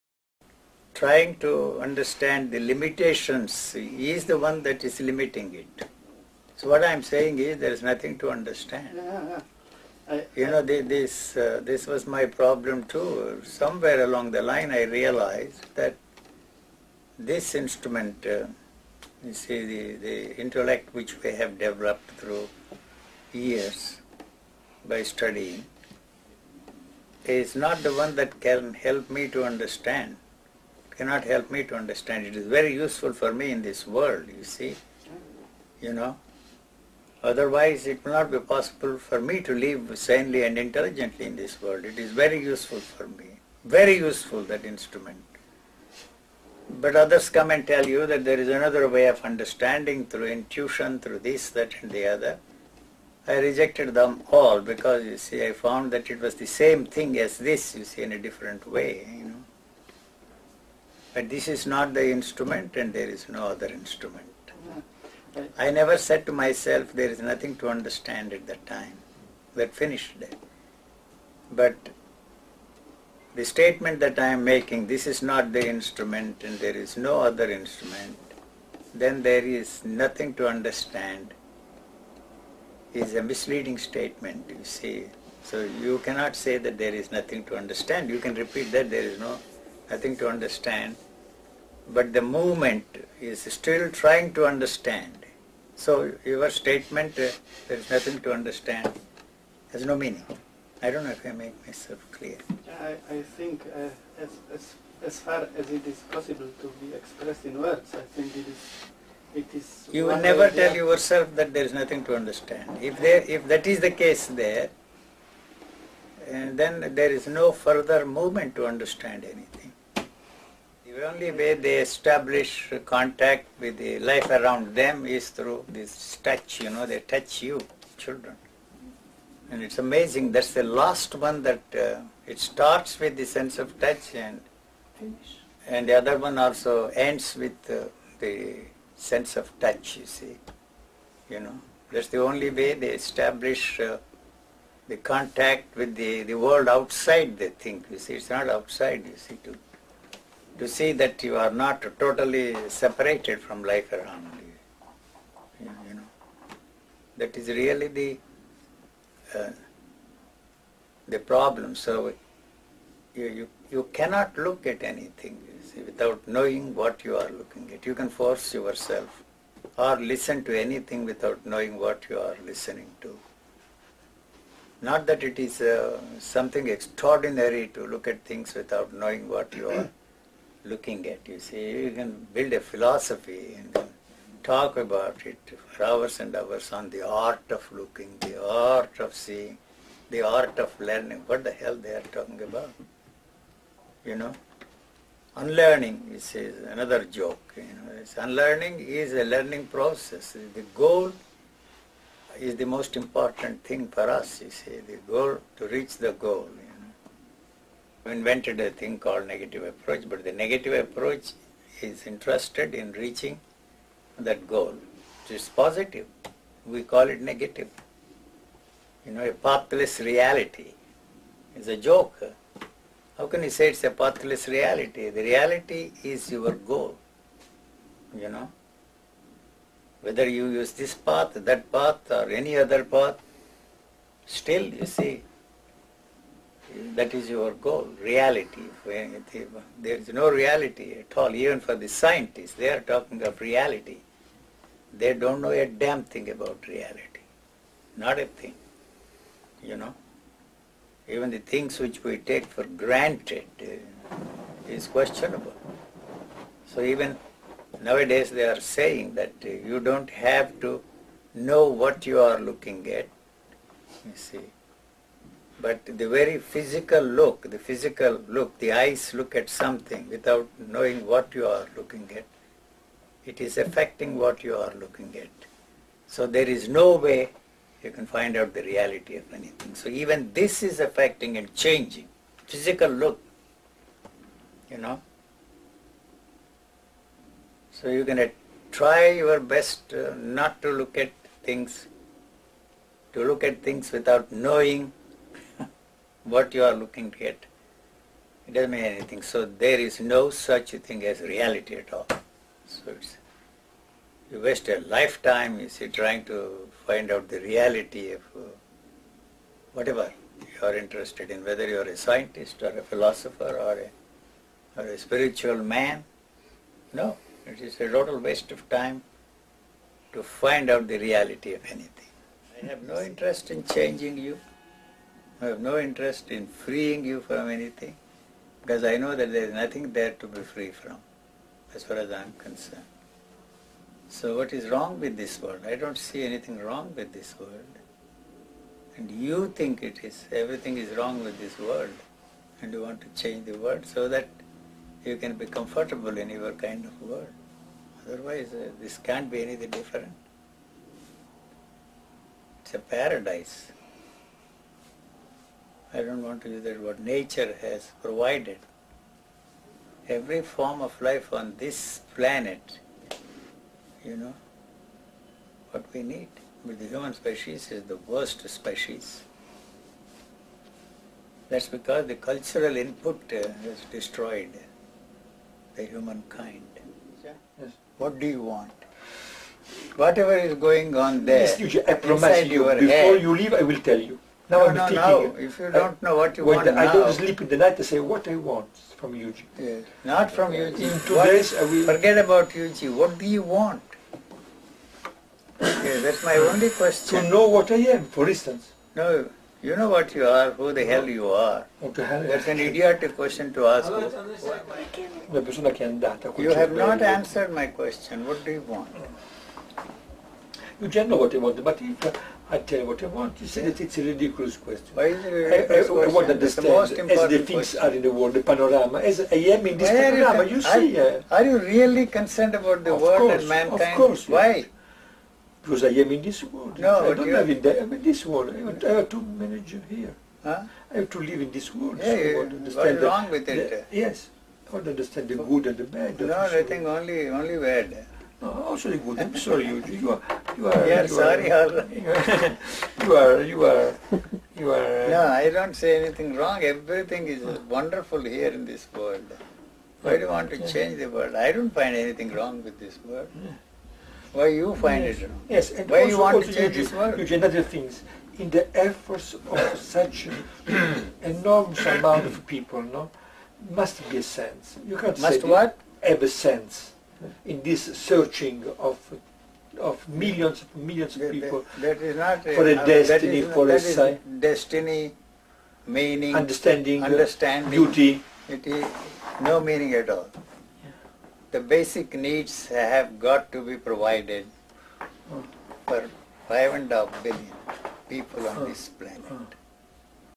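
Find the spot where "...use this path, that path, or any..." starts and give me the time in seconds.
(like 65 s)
230 s.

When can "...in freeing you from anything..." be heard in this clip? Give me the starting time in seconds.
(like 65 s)
326 s.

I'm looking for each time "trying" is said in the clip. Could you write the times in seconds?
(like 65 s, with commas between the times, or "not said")
1 s, 93 s, 305 s.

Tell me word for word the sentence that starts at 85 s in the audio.
So you cannot say that there is nothing to understand.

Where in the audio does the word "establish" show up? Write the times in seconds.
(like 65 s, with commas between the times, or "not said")
121 s, 142 s.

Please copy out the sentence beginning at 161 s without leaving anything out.
So you, you you cannot look at anything see, without knowing what you are looking at.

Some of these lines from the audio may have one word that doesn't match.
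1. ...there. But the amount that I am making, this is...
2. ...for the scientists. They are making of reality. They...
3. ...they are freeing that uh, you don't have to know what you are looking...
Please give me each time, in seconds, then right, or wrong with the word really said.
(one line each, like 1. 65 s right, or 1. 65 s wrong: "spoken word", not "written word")
1. 70 s wrong: "statement", not "amount"
2. 241 s wrong: "talking", not "making"
3. 258 s wrong: "saying", not "freeing".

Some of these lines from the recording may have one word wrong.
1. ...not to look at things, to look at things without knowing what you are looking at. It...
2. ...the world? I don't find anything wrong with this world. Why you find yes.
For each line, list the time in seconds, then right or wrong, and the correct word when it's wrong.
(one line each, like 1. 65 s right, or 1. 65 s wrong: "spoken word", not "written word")
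1. 290 s right
2. 450 s right.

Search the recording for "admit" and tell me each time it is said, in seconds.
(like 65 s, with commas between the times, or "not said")
not said.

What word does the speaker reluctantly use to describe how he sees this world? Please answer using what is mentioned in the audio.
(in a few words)
paradise.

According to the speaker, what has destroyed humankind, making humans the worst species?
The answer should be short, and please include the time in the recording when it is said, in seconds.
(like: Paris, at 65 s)
cultural input, at 372 s.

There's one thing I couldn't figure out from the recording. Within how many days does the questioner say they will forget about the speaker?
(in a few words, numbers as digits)
2.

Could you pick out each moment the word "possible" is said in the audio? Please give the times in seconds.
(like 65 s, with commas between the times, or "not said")
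38 s, 106 s.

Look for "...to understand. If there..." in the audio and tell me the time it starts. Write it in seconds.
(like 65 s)
112 s.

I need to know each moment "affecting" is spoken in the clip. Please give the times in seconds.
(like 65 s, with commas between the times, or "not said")
273 s, 280 s.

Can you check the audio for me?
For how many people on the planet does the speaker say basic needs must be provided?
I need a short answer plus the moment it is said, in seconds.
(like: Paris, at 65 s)
5.5 billion, at 486 s.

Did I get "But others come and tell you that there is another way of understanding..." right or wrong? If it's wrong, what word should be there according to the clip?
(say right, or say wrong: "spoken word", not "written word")
right.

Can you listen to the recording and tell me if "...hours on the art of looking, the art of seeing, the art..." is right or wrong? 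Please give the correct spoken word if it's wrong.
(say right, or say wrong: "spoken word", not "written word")
right.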